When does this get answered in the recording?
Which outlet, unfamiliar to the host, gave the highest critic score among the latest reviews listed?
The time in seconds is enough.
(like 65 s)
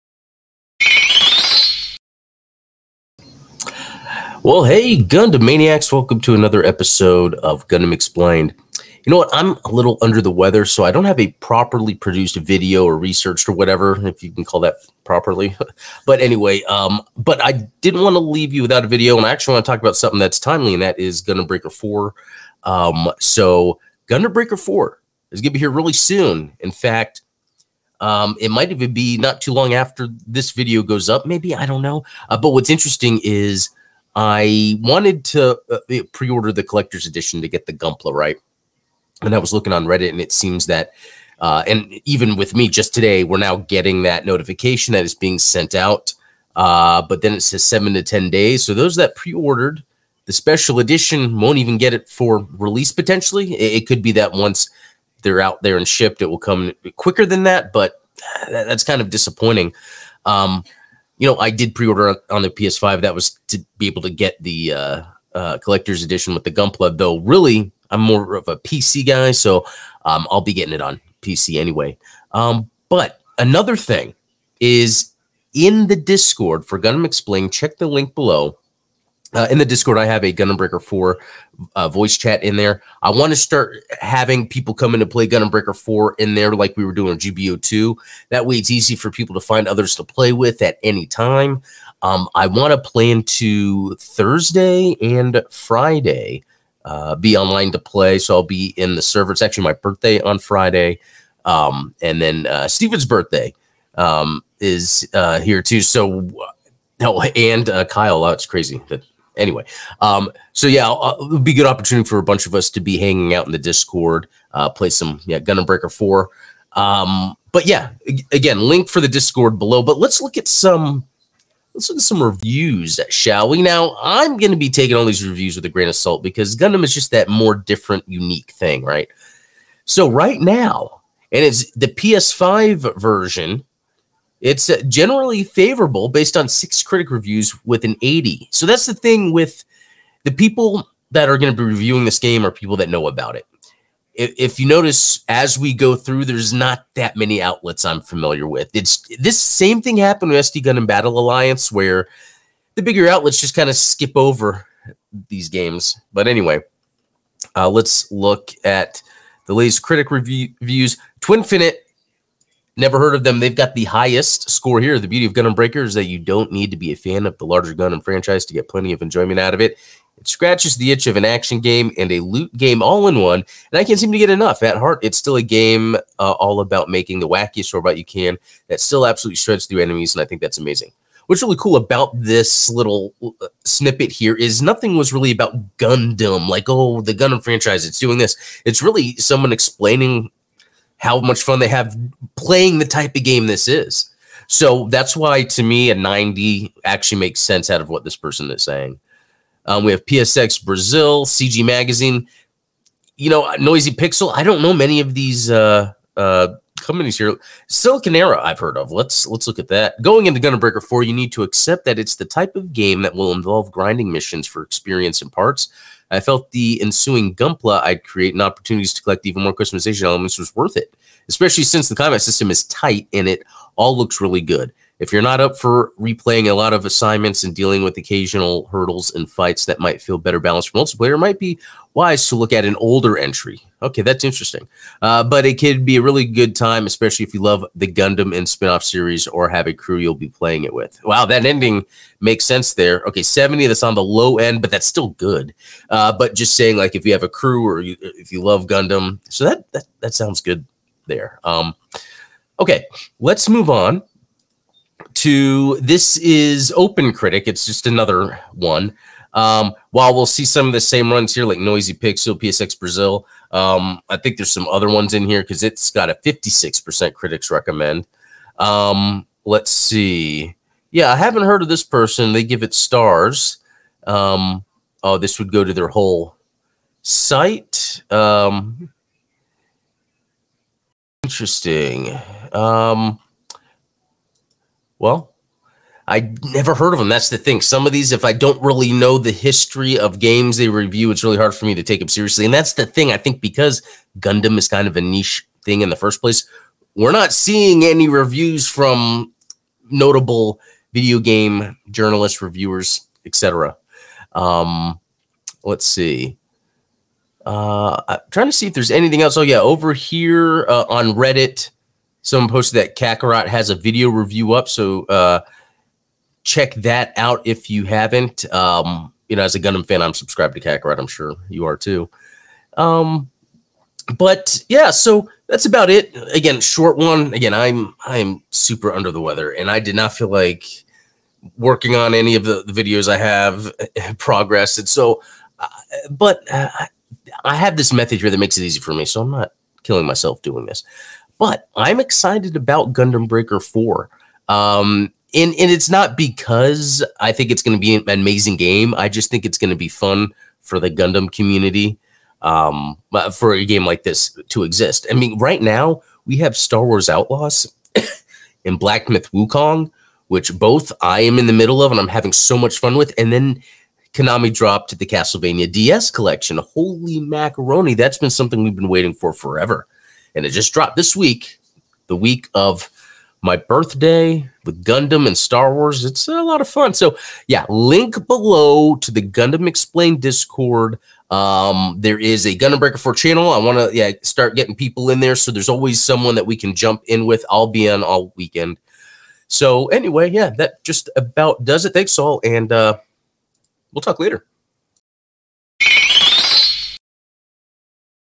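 161 s.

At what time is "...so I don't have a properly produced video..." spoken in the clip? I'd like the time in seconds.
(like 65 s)
10 s.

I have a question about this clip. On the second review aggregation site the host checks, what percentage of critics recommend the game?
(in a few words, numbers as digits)
56%.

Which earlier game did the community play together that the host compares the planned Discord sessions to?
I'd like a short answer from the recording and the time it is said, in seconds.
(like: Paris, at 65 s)
GBO 2, at 87 s.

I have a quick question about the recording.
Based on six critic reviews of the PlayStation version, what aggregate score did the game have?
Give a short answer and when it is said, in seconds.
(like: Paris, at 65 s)
80, at 138 s.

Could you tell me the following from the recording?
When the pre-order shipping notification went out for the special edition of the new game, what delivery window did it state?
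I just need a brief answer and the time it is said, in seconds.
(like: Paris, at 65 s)
7 to 10 days, at 47 s.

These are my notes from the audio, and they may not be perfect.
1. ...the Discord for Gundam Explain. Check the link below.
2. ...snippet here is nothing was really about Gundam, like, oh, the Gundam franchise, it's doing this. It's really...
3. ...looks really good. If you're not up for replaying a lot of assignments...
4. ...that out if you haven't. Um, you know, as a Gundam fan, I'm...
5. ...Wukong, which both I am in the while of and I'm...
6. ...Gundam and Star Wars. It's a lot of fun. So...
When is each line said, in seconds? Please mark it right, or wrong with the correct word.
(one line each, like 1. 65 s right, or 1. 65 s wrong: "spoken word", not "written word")
1. 75 s right
2. 183 s right
3. 223 s right
4. 316 s right
5. 359 s wrong: "middle", not "while"
6. 374 s right.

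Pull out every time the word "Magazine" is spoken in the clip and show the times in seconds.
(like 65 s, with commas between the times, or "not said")
201 s.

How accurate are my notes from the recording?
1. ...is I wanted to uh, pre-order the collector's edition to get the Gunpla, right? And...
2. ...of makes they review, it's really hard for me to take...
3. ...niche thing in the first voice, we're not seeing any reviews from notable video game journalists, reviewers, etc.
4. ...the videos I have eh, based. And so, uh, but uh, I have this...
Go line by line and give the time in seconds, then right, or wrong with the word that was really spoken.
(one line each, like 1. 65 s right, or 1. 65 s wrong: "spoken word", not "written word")
1. 33 s right
2. 289 s wrong: "games", not "makes"
3. 295 s wrong: "place", not "voice"
4. 332 s wrong: "progressed", not "based".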